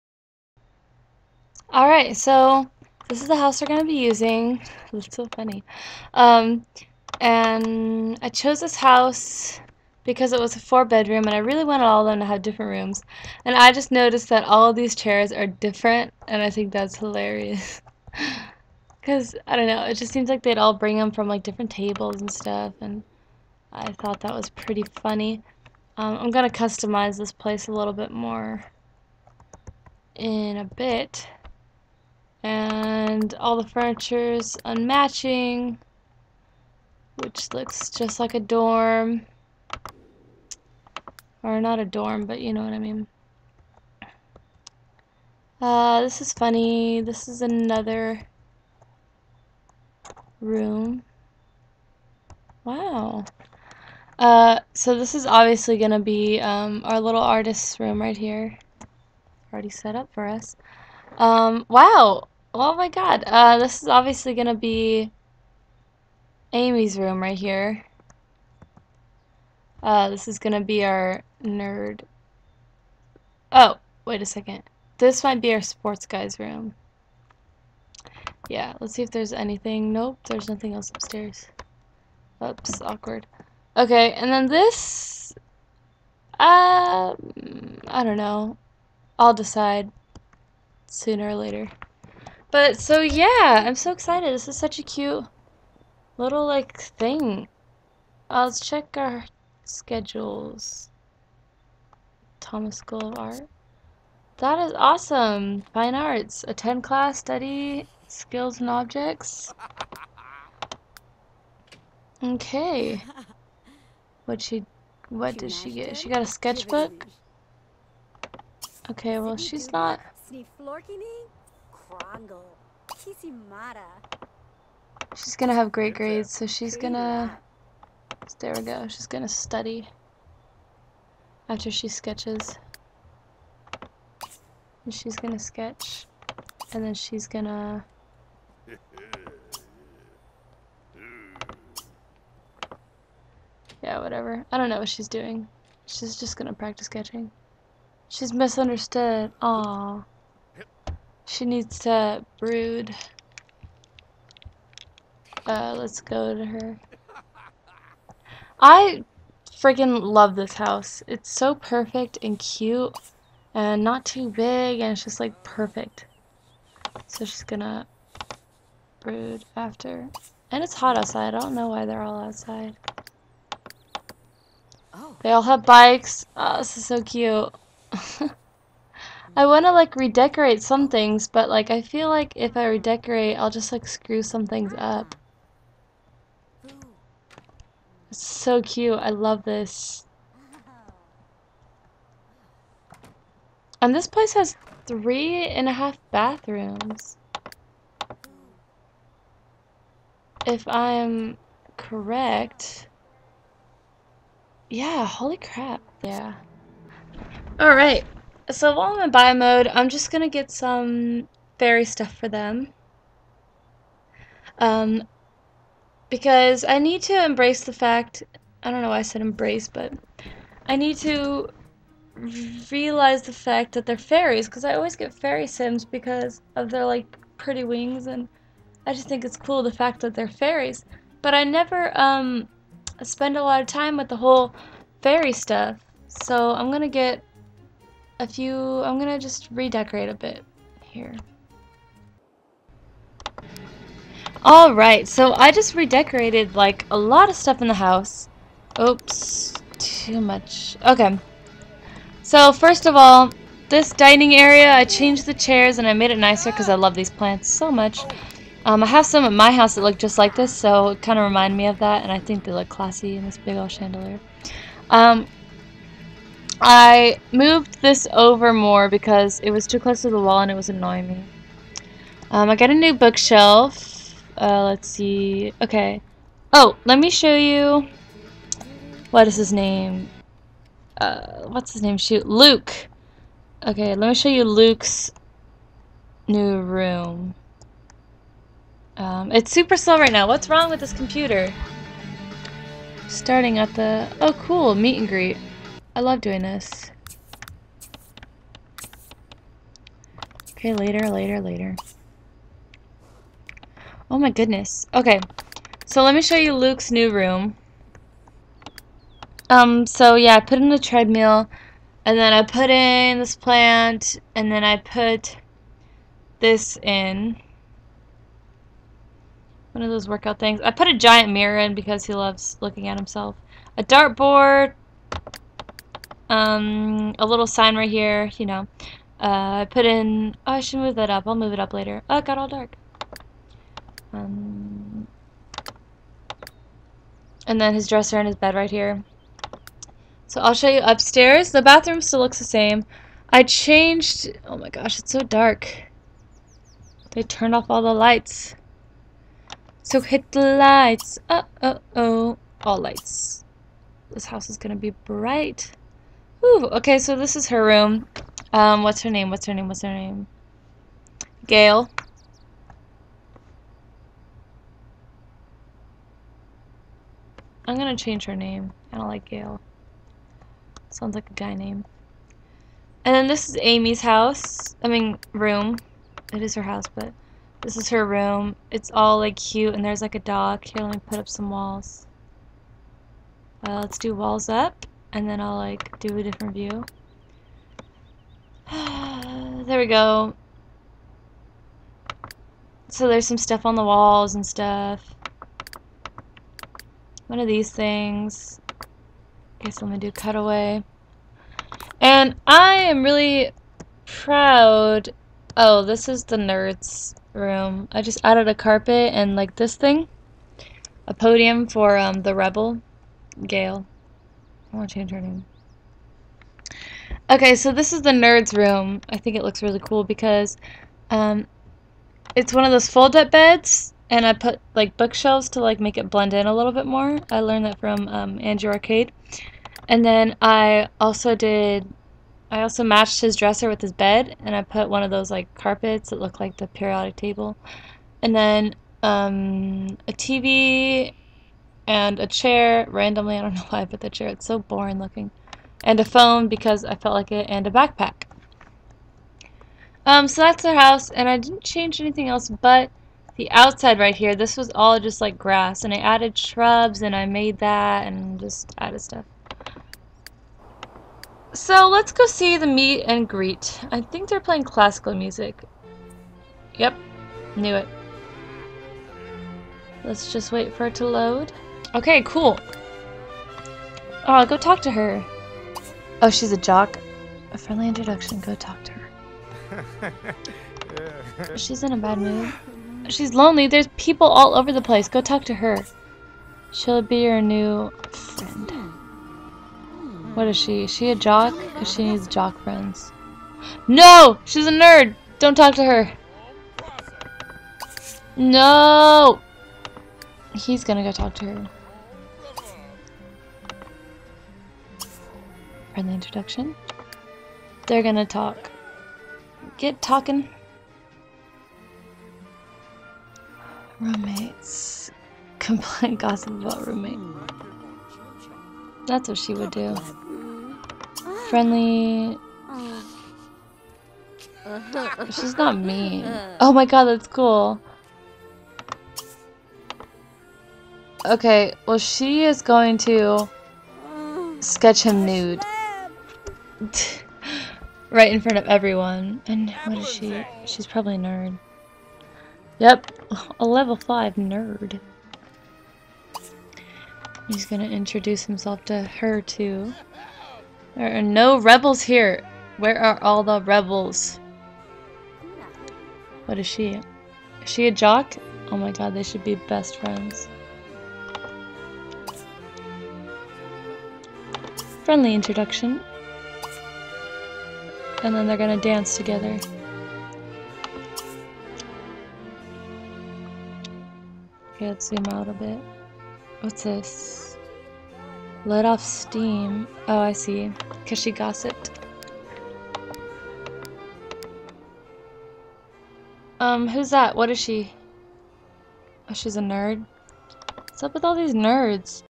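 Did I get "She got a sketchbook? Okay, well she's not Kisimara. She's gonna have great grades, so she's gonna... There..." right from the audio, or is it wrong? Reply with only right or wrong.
right.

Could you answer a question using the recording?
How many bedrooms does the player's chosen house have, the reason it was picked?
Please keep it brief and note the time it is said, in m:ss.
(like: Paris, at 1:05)
4, at 0:10.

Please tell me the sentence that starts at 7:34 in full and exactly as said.
This was all just like grass, and I added shrubs, and I made that, and just added stuff.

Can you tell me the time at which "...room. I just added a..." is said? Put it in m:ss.
6:47.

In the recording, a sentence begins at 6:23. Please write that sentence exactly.
Uh, let's do walls up and then I'll like do a different view.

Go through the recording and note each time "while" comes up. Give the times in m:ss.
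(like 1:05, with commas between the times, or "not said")
3:28.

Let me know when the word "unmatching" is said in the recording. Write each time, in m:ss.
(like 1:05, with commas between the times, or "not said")
0:34.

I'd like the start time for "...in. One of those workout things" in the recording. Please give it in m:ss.
5:16.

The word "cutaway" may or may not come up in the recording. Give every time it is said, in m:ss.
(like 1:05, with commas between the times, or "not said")
6:40.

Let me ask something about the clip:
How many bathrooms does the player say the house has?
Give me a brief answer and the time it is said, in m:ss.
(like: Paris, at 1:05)
3.5, at 3:14.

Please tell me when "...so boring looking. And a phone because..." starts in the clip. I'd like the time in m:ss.
7:24.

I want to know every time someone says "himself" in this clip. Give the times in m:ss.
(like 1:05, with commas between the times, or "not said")
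5:22, 9:08.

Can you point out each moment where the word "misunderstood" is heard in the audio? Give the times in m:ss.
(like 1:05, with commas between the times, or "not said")
2:28.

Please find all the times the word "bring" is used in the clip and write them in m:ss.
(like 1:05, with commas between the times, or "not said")
0:20.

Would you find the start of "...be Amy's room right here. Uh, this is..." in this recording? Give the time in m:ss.
1:04.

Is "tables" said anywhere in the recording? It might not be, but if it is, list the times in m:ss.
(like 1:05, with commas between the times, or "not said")
0:21, 7:17.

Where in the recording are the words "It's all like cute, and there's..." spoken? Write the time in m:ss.
6:18.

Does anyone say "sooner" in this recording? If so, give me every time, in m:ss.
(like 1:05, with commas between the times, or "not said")
1:30.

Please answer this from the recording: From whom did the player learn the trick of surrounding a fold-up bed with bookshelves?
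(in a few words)
Andrew Arcade.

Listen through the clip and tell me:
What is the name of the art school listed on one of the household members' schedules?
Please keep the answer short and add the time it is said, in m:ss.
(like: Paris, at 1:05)
Thomas School of Art, at 1:42.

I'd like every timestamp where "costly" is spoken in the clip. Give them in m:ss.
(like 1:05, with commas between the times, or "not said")
not said.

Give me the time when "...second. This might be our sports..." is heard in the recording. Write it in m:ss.
1:14.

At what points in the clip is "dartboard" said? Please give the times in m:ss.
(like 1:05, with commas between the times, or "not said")
5:23.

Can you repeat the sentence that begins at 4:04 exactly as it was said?
Alright, so I just redecorated like a lot of stuff in the house.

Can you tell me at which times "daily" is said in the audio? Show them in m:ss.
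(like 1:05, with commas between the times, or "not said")
not said.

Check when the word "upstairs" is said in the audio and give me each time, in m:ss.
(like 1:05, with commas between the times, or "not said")
1:20, 5:40.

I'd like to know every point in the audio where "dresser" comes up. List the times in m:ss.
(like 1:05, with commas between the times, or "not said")
5:37, 7:13.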